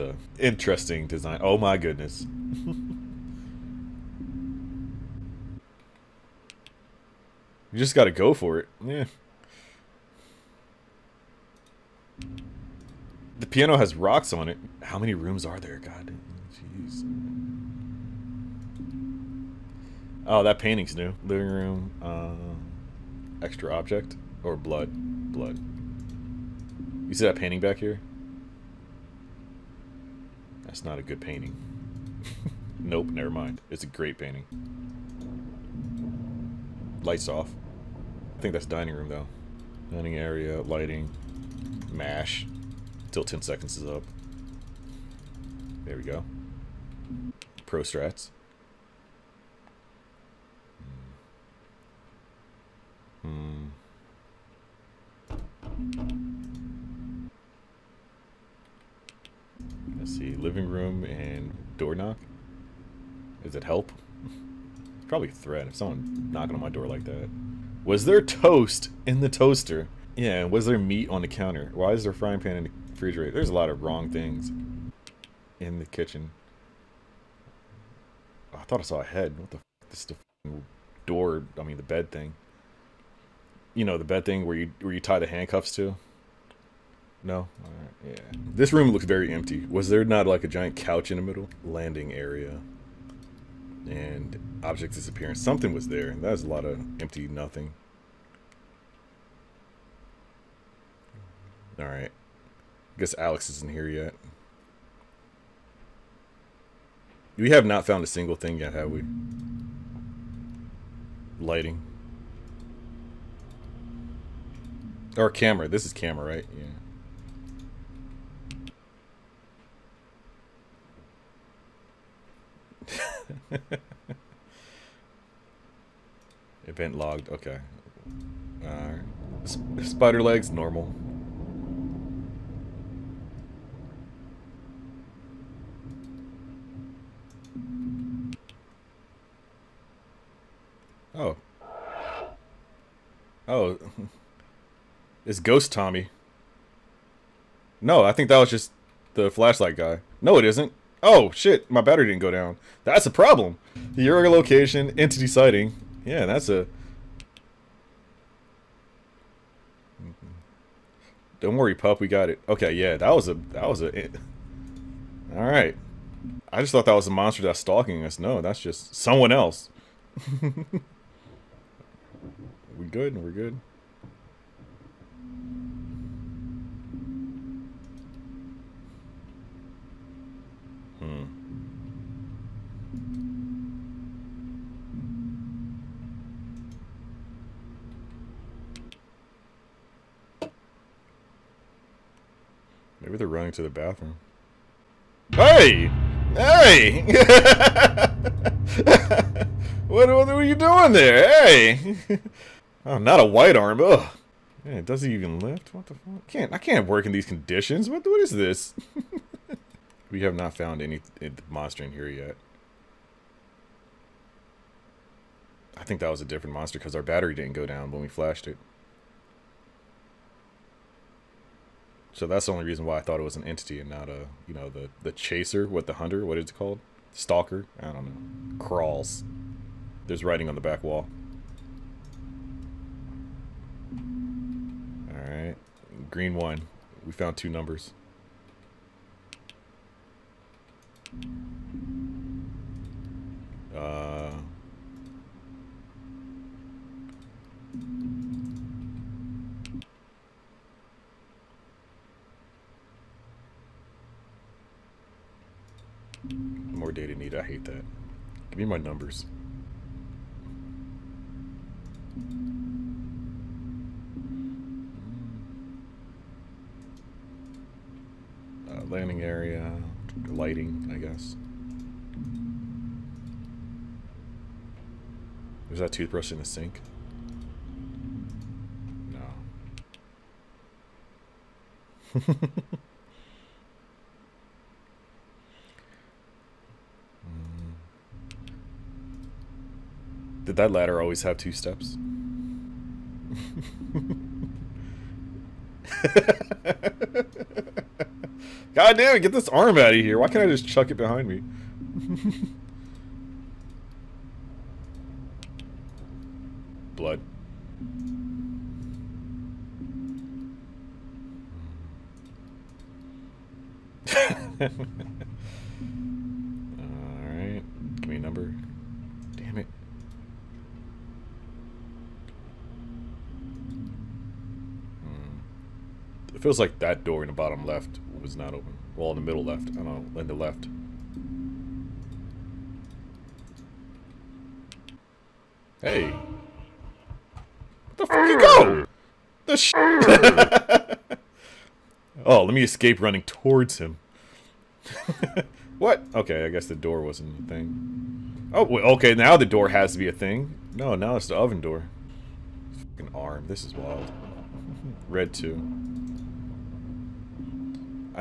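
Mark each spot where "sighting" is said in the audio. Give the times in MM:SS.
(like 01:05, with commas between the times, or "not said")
02:35.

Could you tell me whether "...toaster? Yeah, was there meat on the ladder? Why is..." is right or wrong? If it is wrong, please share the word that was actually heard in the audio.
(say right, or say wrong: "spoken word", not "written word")
wrong: "counter", not "ladder".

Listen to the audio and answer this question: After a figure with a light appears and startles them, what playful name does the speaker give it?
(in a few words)
Ghost Tommy.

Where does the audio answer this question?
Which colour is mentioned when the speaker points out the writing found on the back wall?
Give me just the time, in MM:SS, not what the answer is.
03:56.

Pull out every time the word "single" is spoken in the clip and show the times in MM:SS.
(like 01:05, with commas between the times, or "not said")
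01:48.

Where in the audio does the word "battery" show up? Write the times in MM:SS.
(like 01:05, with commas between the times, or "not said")
02:31, 03:37.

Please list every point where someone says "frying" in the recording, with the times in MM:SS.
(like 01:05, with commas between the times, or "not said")
01:12.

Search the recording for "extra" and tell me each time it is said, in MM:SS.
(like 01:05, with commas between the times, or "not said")
00:23.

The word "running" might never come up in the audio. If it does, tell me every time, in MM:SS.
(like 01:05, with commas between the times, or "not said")
03:13, 05:43.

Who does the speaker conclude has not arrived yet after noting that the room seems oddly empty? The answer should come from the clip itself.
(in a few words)
Alex.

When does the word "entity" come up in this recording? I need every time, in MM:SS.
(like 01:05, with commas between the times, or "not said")
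02:34, 03:43.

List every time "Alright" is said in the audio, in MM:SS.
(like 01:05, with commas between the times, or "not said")
01:27, 02:45, 03:55.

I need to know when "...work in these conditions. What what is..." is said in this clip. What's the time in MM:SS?
03:26.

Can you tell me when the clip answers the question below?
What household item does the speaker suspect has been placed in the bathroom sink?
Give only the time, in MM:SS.
04:35.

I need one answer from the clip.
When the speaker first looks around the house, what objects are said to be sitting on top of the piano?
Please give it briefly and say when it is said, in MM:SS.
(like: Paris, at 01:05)
Rocks, at 00:13.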